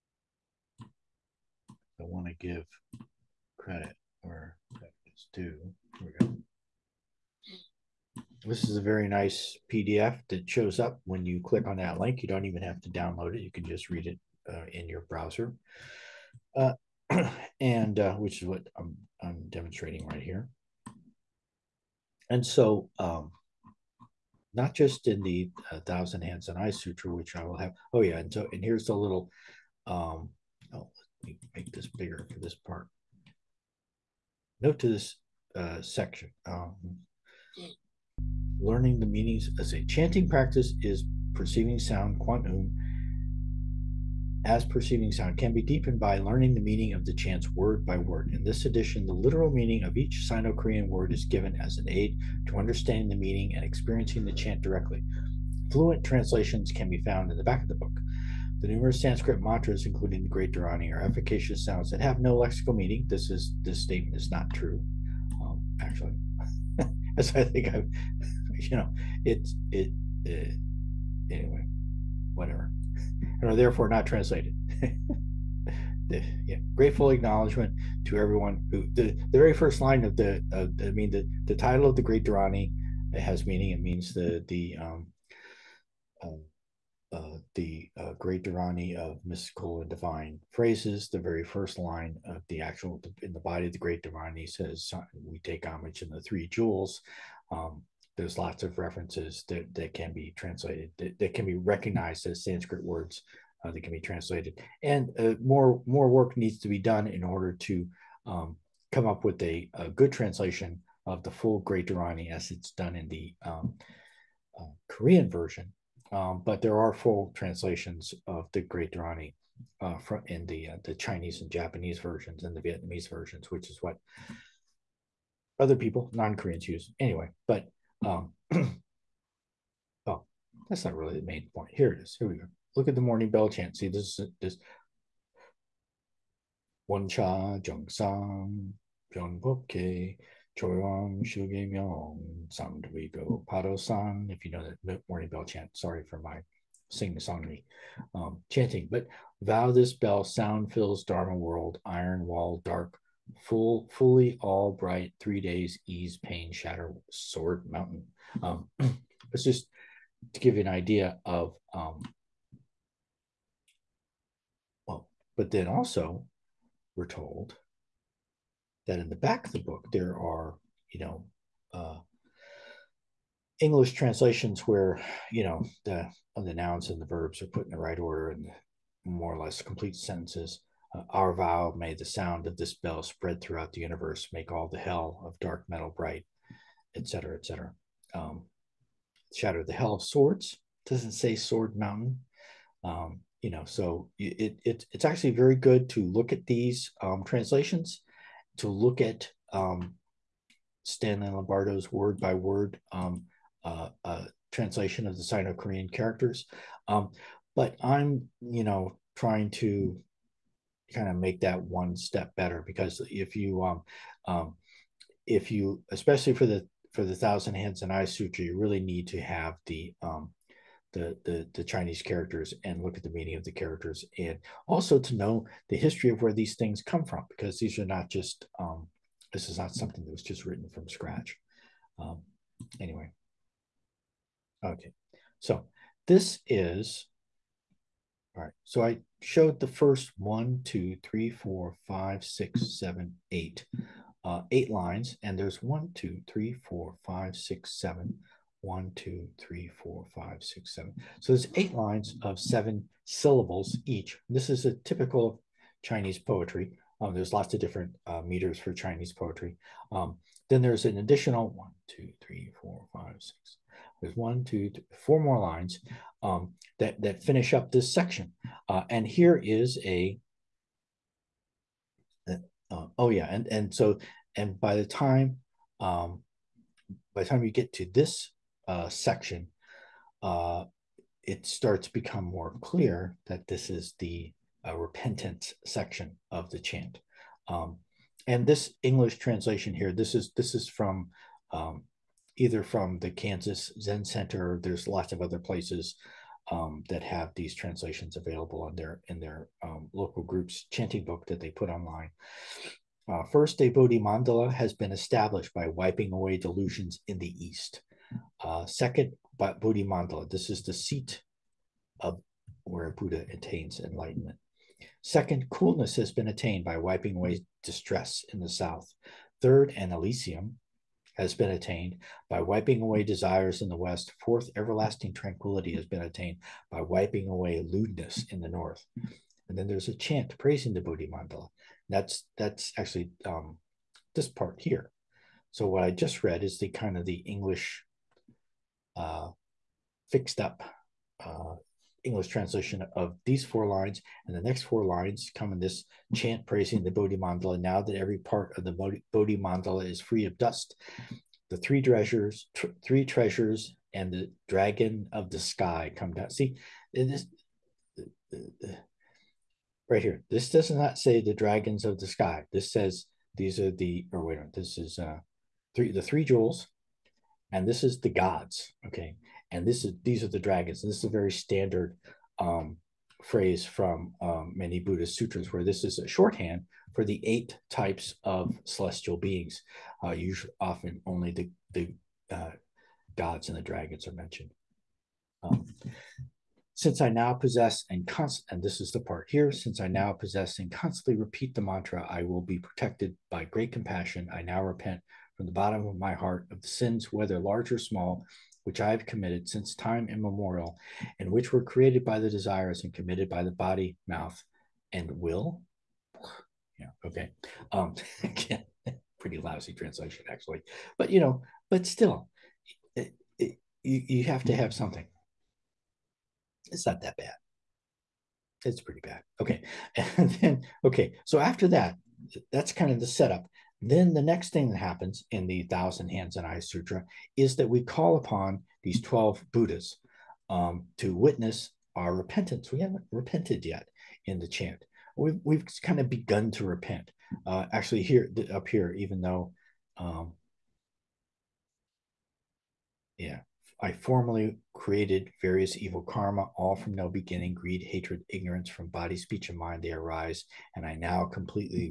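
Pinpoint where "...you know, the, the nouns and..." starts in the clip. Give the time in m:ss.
2:55.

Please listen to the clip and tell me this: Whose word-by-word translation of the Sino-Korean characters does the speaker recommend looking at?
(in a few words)
Stanley Lombardo.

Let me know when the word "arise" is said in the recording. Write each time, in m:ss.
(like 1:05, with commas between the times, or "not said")
7:29.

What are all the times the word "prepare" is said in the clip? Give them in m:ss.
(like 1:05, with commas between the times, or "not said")
not said.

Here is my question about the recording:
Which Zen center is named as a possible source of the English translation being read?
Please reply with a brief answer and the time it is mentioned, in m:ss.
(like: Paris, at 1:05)
Kansas Zen Center, at 4:53.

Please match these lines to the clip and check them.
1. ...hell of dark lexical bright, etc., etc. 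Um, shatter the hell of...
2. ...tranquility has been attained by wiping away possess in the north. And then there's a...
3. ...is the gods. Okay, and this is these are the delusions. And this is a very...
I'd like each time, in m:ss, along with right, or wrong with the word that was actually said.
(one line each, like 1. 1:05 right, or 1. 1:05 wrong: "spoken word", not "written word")
1. 3:04 wrong: "metal", not "lexical"
2. 5:25 wrong: "lewdness", not "possess"
3. 6:07 wrong: "dragons", not "delusions".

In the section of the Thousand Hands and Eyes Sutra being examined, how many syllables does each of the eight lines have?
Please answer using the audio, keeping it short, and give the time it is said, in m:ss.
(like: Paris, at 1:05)
7, at 4:12.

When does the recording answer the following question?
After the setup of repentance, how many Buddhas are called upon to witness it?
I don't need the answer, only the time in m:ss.
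7:08.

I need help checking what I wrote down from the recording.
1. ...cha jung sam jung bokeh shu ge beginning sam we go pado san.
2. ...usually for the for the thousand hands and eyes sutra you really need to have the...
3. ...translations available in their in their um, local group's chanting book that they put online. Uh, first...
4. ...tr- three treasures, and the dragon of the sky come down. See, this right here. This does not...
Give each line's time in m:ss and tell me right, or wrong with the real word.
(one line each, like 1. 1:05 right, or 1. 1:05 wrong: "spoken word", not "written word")
1. 2:17 wrong: "myong", not "beginning"
2. 3:35 wrong: "especially", not "usually"
3. 4:57 right
4. 5:52 right.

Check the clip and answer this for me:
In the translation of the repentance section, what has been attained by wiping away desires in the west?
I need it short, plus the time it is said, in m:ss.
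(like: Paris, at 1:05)
An Elysium, at 5:19.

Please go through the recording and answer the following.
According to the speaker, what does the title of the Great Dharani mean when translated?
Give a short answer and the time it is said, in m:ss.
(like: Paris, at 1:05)
Great Dharani of mystical and divine phrases, at 1:28.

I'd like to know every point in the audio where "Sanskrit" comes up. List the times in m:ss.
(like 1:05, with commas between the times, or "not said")
0:59, 1:42.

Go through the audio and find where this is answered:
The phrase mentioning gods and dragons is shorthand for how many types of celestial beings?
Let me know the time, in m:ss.
6:17.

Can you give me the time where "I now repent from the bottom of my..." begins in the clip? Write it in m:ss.
6:34.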